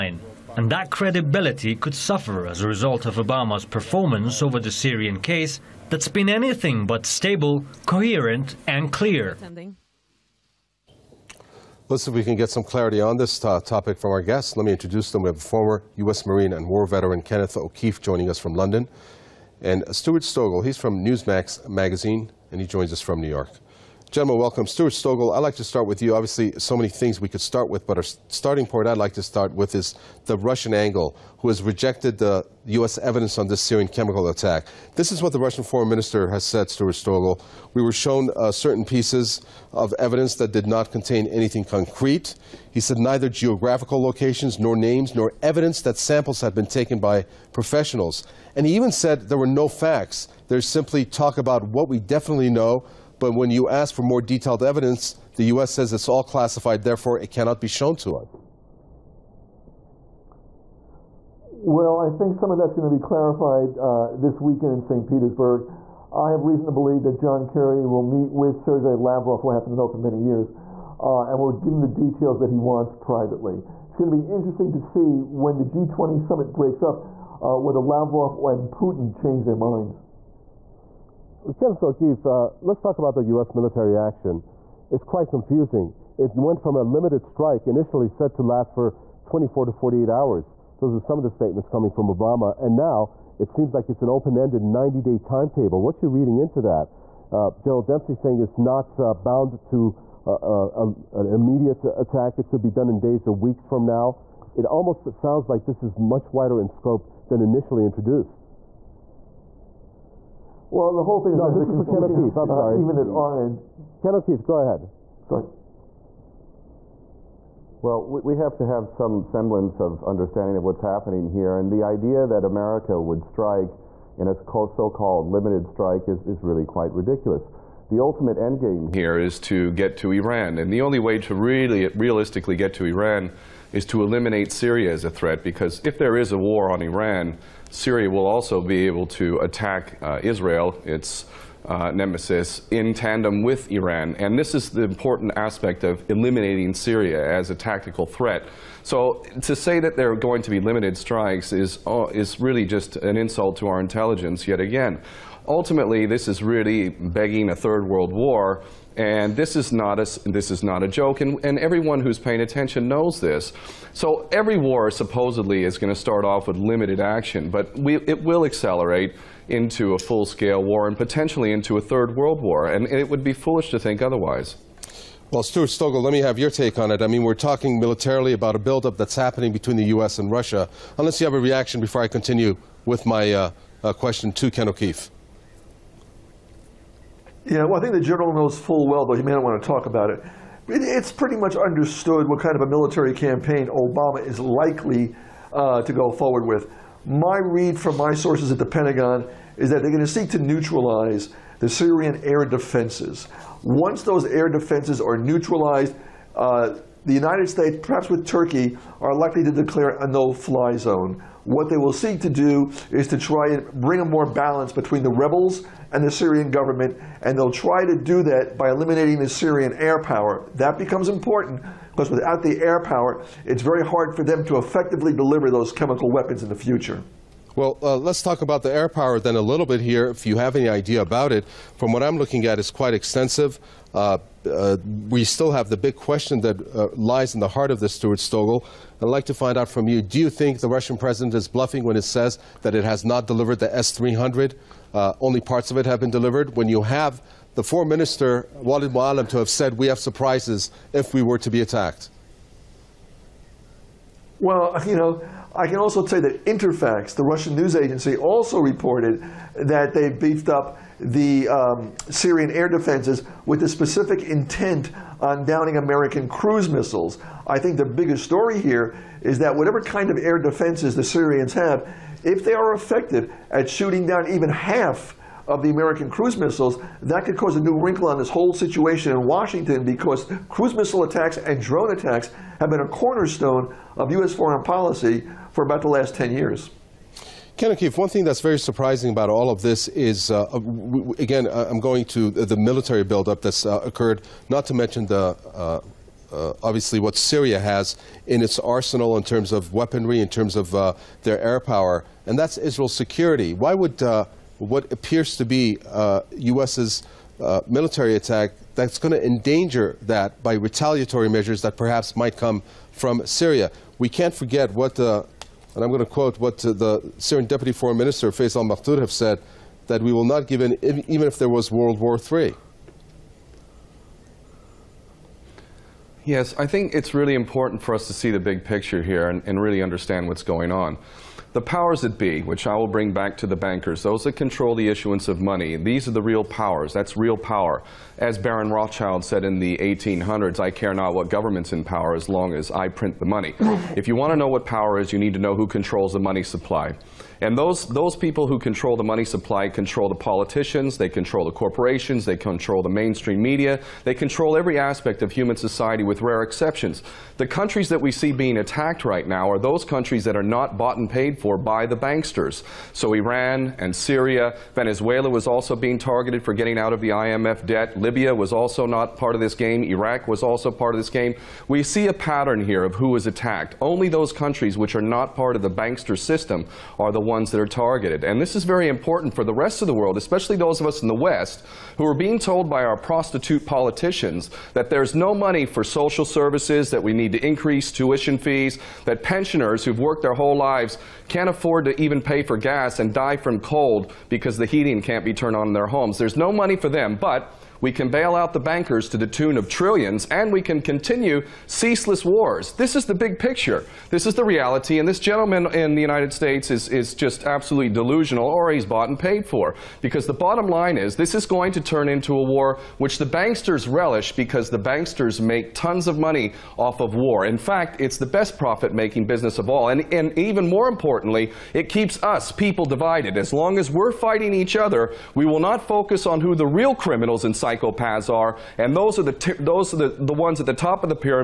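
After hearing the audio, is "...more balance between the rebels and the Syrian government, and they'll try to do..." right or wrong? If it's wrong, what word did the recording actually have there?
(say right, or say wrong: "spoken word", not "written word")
right.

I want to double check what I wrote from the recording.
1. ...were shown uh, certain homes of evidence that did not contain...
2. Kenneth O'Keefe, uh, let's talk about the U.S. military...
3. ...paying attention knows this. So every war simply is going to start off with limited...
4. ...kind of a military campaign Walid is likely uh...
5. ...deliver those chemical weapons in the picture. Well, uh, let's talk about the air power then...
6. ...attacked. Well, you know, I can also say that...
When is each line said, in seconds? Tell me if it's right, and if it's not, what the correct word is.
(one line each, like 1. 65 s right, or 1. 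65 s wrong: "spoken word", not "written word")
1. 37 s wrong: "pieces", not "homes"
2. 81 s right
3. 162 s wrong: "supposedly", not "simply"
4. 192 s wrong: "Obama", not "Walid"
5. 225 s wrong: "future", not "picture"
6. 251 s right.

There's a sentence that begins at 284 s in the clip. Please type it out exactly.
foreign policy for about the last 10 years.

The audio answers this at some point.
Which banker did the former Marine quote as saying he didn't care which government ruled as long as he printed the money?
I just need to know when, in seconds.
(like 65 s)
338 s.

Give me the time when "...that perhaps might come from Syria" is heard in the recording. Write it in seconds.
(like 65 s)
311 s.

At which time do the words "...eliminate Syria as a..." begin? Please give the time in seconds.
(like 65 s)
134 s.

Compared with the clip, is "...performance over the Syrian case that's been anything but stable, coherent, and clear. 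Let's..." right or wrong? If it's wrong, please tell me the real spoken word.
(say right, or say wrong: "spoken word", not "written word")
right.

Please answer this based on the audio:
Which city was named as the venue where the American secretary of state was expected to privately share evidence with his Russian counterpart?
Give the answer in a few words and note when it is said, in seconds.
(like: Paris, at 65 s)
St. Petersburg, at 64 s.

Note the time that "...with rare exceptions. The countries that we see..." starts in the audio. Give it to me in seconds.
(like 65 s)
356 s.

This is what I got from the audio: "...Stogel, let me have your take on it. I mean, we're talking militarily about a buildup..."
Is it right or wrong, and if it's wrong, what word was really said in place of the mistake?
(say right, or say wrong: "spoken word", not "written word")
right.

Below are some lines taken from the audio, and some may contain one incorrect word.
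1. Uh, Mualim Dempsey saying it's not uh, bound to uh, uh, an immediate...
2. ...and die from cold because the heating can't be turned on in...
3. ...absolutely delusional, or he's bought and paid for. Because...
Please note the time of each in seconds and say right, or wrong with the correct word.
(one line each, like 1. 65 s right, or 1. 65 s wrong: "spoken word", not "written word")
1. 97 s wrong: "General", not "Mualim"
2. 392 s right
3. 407 s right.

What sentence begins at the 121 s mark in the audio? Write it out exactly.
And the idea that America would strike in a so-called limited strike is, is really quite ridiculous.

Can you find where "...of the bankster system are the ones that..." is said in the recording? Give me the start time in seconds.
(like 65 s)
375 s.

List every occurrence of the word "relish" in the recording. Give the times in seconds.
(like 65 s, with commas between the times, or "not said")
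413 s.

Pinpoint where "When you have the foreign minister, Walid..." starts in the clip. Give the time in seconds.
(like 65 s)
246 s.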